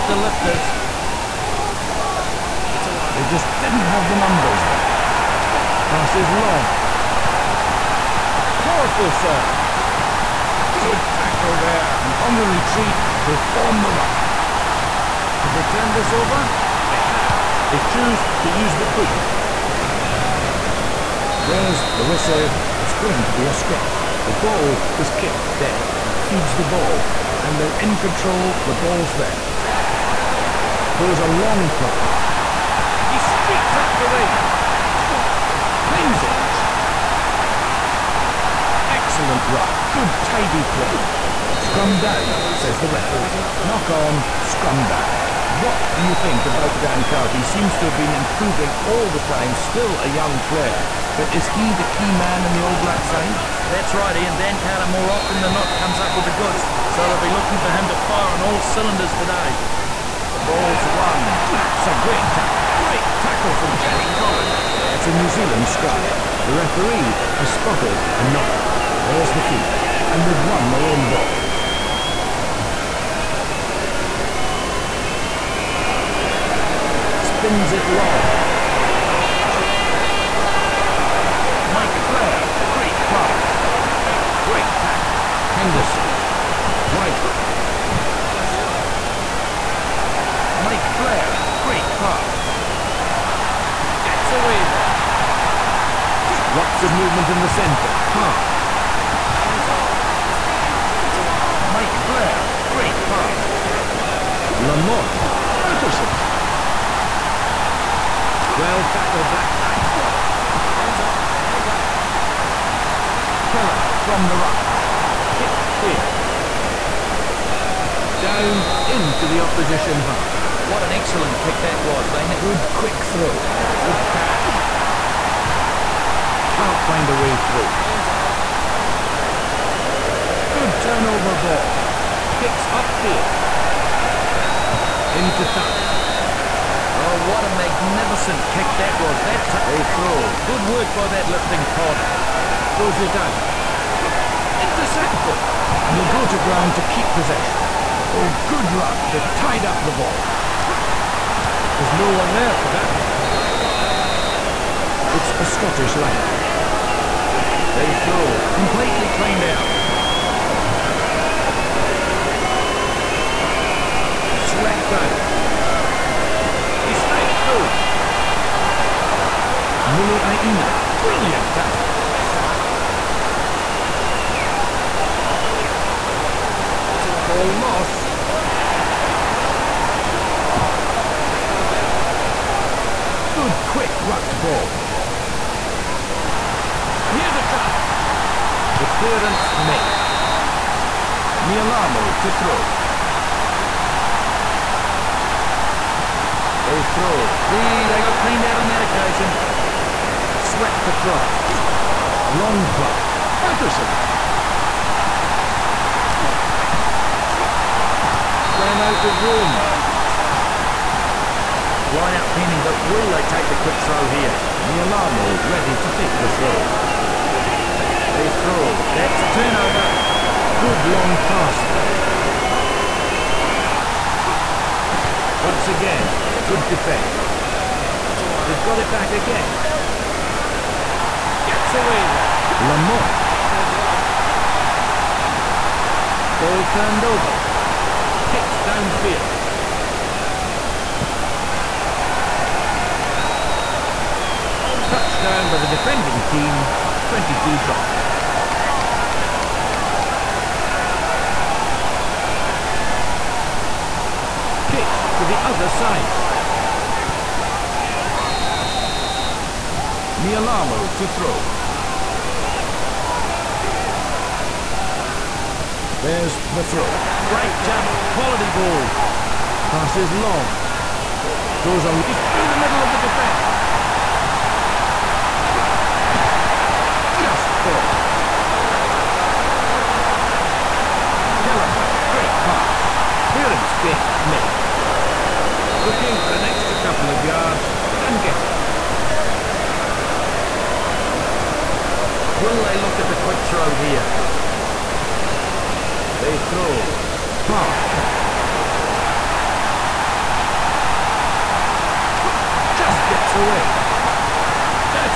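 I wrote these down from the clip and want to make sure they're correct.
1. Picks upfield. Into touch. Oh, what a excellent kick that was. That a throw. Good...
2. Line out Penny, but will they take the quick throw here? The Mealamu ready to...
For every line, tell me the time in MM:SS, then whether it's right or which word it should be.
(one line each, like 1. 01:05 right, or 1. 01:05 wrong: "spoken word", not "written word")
1. 02:12 wrong: "magnificent", not "excellent"
2. 03:31 right.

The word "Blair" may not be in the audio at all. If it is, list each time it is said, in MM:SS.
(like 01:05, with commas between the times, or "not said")
01:22, 01:31, 01:42.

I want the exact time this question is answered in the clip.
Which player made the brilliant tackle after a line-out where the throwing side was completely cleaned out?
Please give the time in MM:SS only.
02:49.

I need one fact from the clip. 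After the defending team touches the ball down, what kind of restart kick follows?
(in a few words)
22 drop.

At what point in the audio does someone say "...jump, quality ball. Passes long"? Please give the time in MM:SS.
04:27.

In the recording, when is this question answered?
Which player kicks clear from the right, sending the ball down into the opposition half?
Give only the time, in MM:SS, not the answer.
01:53.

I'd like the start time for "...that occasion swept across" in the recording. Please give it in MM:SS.
03:18.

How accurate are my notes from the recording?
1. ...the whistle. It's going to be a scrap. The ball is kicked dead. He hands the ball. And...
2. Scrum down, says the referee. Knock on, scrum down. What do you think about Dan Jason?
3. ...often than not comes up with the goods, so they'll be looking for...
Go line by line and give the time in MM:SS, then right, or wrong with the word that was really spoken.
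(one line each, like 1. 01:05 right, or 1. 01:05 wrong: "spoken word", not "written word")
1. 00:21 wrong: "feeds", not "hands"
2. 00:41 wrong: "Carter", not "Jason"
3. 00:55 right.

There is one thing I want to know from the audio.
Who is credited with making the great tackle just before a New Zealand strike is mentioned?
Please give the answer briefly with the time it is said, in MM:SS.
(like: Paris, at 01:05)
Jason Collins, at 01:03.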